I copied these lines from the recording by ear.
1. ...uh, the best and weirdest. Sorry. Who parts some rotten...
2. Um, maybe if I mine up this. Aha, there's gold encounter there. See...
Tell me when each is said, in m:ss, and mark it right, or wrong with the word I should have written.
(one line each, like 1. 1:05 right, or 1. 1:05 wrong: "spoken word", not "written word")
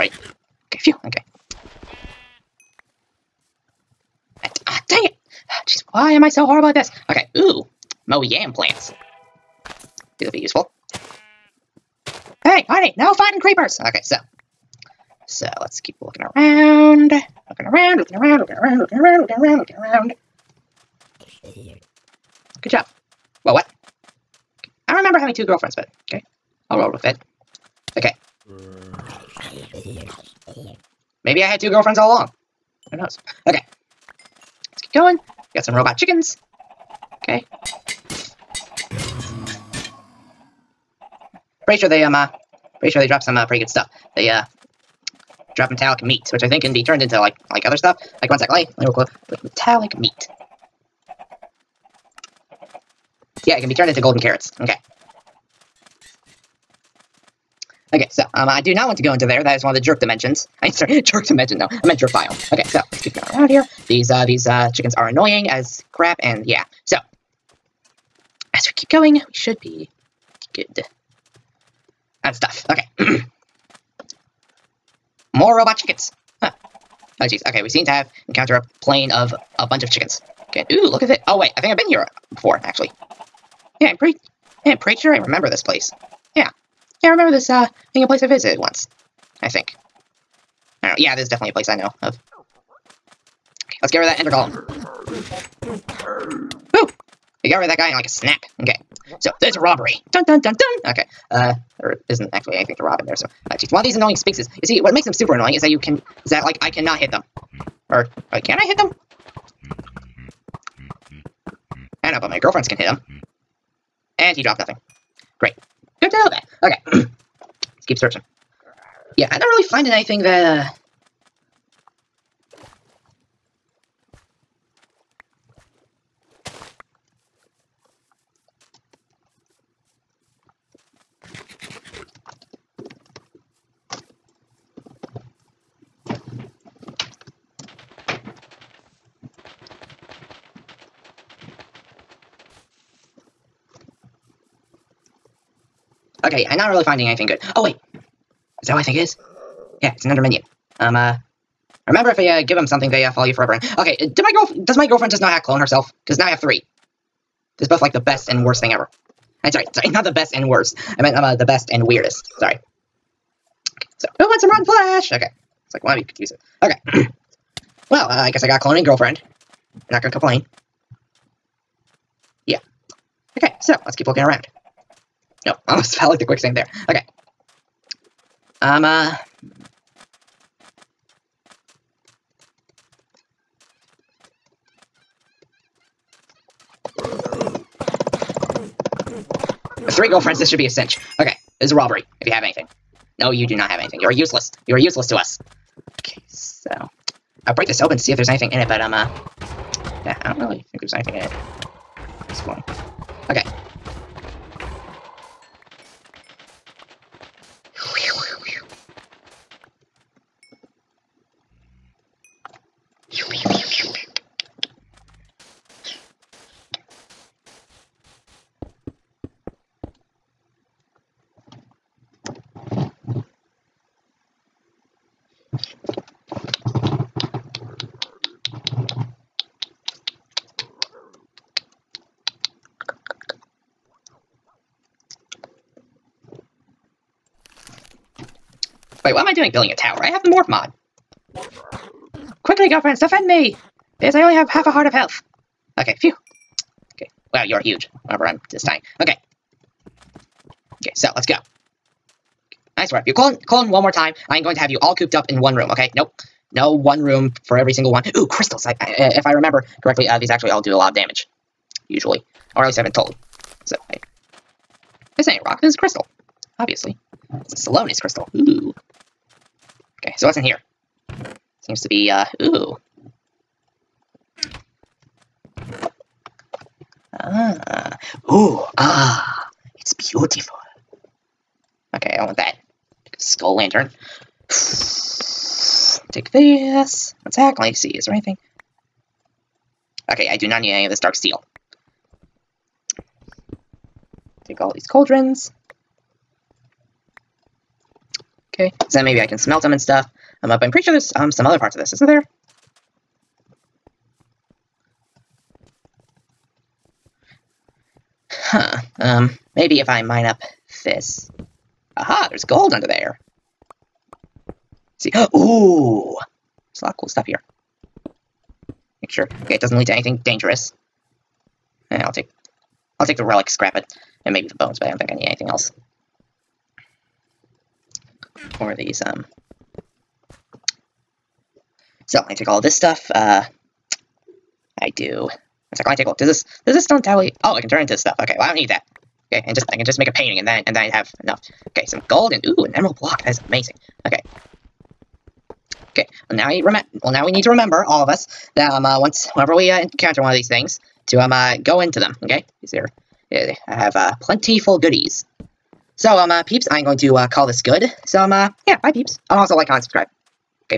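1. 2:41 wrong: "wants", not "parts"
2. 5:09 wrong: "under", not "encounter".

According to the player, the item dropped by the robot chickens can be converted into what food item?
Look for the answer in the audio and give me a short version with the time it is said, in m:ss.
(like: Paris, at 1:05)
golden carrots, at 0:53.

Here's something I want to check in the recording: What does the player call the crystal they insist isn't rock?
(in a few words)
Salonis crystal.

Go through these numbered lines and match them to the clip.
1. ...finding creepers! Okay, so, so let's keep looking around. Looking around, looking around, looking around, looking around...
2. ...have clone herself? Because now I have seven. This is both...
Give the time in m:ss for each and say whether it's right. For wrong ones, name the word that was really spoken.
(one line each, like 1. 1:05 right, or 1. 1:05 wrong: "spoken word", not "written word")
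1. 0:13 wrong: "fighting", not "finding"
2. 2:35 wrong: "three", not "seven".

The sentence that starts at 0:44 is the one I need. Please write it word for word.
They uh drop metallic meat, which I think can be turned into like like other stuff.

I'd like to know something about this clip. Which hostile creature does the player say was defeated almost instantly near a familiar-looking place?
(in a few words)
Ender Golem.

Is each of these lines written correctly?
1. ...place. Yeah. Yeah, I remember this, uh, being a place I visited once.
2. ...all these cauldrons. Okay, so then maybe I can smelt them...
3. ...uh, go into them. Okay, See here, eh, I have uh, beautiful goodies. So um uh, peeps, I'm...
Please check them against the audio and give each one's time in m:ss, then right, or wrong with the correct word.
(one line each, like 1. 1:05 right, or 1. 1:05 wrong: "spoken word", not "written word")
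1. 1:25 right
2. 4:54 right
3. 5:51 wrong: "plentiful", not "beautiful".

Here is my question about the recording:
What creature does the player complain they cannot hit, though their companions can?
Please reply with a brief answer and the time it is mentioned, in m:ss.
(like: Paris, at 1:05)
sphinxes, at 1:44.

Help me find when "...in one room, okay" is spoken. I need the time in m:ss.
4:15.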